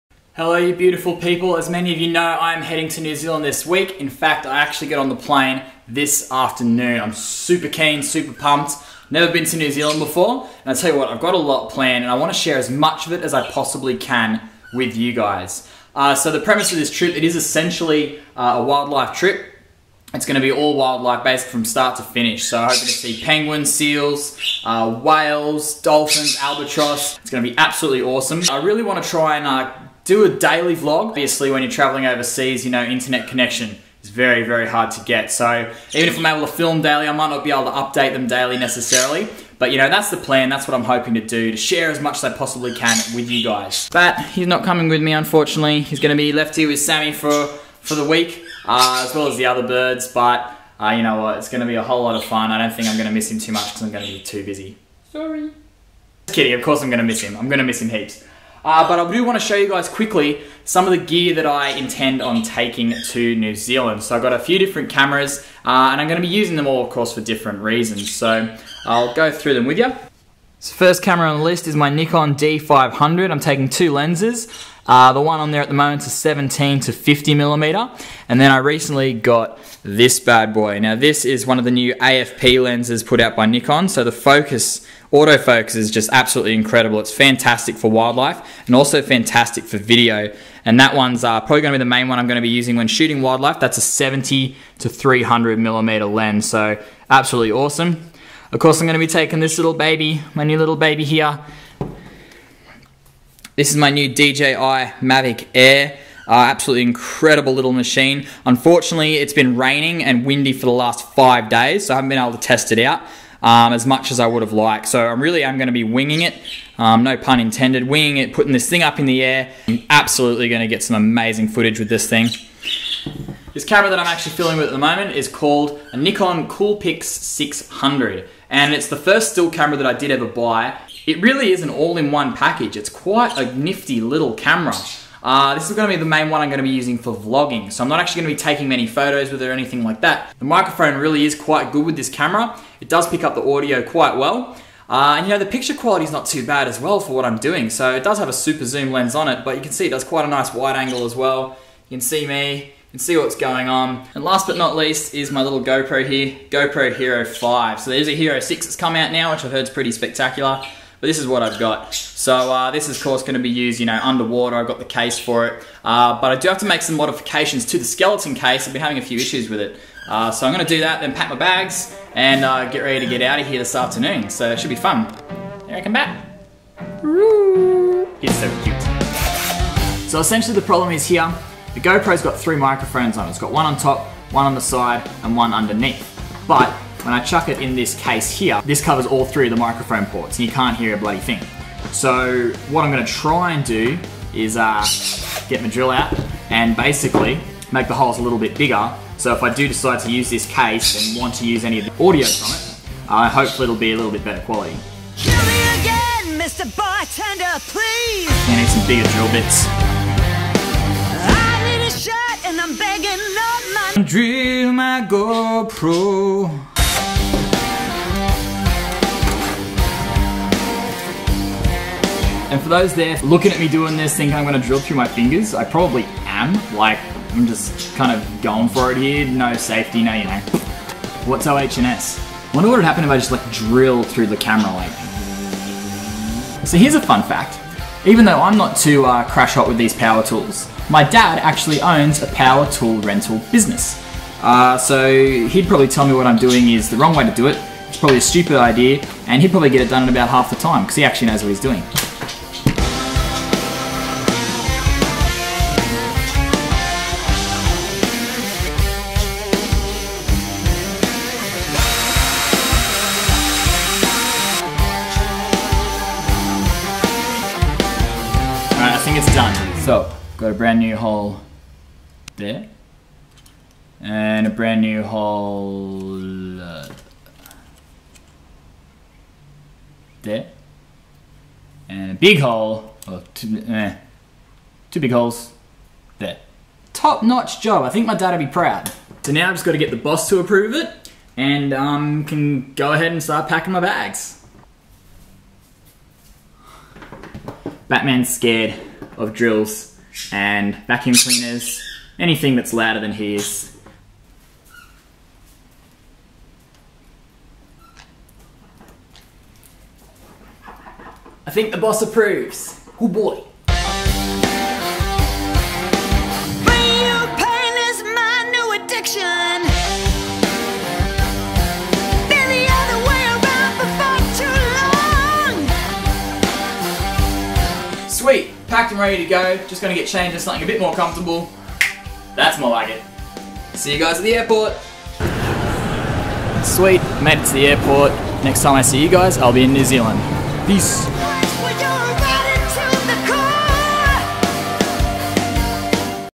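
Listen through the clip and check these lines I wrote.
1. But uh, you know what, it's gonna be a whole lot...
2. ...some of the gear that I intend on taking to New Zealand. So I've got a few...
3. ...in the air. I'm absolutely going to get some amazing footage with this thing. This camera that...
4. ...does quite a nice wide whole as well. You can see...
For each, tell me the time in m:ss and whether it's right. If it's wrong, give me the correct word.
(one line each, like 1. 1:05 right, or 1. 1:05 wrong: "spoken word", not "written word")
1. 0:50 right
2. 1:00 right
3. 1:58 right
4. 2:29 wrong: "angle", not "whole".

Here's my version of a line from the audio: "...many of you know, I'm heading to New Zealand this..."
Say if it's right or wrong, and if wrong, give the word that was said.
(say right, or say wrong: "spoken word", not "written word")
right.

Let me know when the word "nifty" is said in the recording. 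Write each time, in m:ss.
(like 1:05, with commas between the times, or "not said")
2:13.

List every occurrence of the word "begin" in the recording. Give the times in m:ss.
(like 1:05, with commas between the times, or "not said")
not said.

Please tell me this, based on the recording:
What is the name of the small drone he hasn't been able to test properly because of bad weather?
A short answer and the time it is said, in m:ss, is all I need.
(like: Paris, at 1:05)
DJI Mavic Air, at 1:44.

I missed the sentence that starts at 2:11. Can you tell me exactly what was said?
It really is an all-in-one package.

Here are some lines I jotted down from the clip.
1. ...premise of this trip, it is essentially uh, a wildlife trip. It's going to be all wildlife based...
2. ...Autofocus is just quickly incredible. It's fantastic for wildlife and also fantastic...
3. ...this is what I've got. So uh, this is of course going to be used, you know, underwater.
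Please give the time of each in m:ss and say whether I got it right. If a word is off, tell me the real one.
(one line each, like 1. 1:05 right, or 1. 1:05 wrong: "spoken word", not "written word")
1. 0:16 right
2. 1:25 wrong: "absolutely", not "quickly"
3. 2:41 right.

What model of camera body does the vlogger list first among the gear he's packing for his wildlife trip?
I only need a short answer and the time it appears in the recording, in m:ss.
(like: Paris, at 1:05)
Nikon D500, at 1:11.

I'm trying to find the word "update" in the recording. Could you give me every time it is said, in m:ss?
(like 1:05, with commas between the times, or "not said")
0:37.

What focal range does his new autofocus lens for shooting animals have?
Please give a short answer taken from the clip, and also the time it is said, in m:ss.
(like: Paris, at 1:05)
70 to 300 millimeter, at 1:33.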